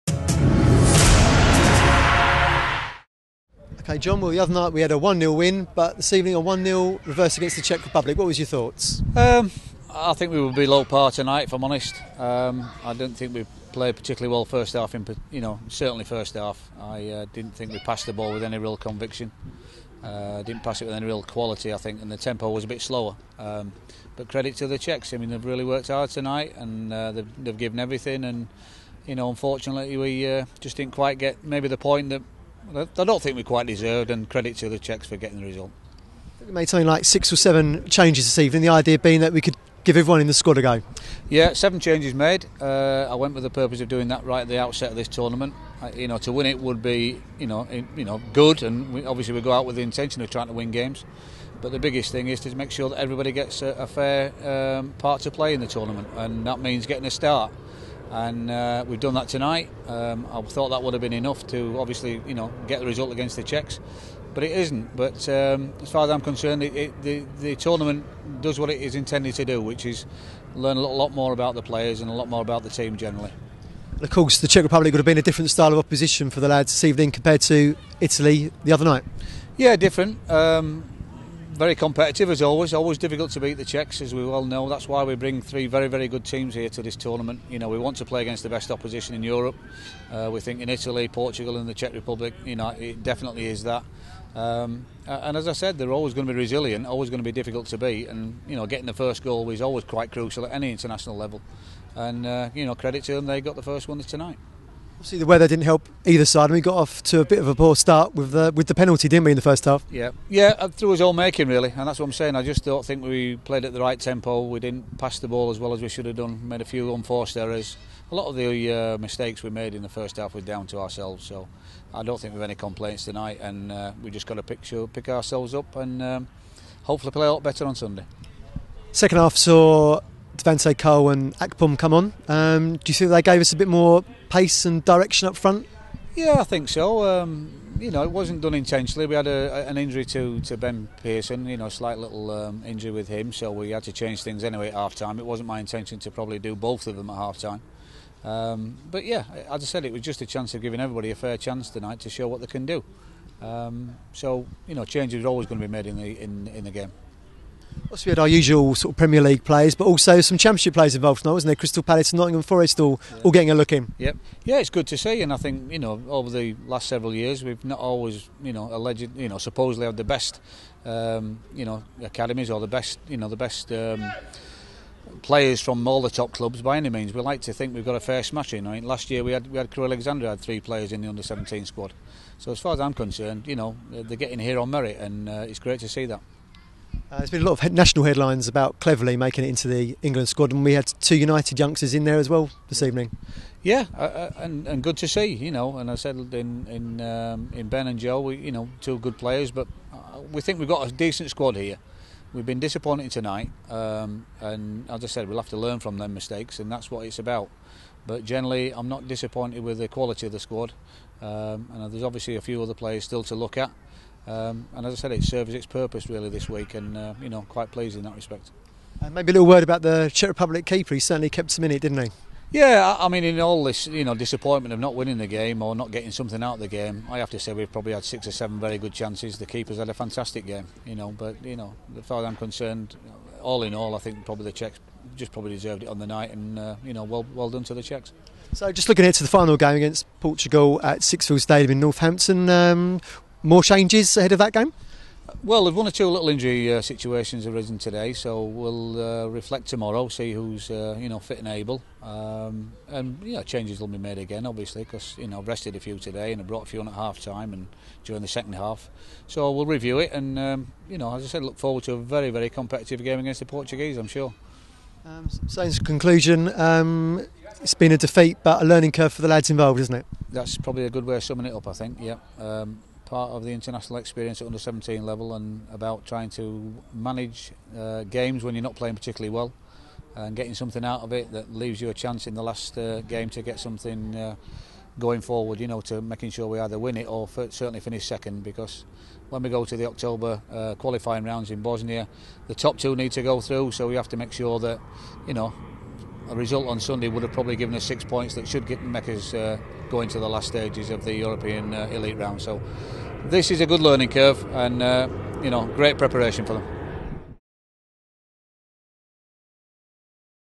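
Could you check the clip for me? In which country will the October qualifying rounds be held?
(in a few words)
Bosnia.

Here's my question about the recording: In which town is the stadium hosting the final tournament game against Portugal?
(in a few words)
Northampton.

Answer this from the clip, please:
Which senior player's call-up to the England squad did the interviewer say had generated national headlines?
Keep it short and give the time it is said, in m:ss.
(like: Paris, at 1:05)
Cleverly, at 3:08.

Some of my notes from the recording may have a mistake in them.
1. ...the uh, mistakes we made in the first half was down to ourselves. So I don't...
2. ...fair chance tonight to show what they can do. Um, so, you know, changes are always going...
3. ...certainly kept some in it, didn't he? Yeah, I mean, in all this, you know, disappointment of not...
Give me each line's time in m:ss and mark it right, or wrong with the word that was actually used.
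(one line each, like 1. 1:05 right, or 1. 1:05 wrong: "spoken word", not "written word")
1. 1:58 right
2. 2:31 right
3. 3:40 right.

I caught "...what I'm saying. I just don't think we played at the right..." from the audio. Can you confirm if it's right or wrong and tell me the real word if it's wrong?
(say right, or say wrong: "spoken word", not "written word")
right.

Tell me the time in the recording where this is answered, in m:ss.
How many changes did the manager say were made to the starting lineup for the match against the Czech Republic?
0:41.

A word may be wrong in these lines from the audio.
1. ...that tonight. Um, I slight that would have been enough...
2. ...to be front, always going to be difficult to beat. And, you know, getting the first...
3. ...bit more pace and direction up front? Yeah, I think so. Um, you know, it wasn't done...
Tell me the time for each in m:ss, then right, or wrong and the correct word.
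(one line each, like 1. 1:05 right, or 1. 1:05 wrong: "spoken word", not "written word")
1. 0:59 wrong: "thought", not "slight"
2. 1:36 wrong: "resilient", not "front"
3. 2:13 right.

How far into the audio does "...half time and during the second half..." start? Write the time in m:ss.
4:16.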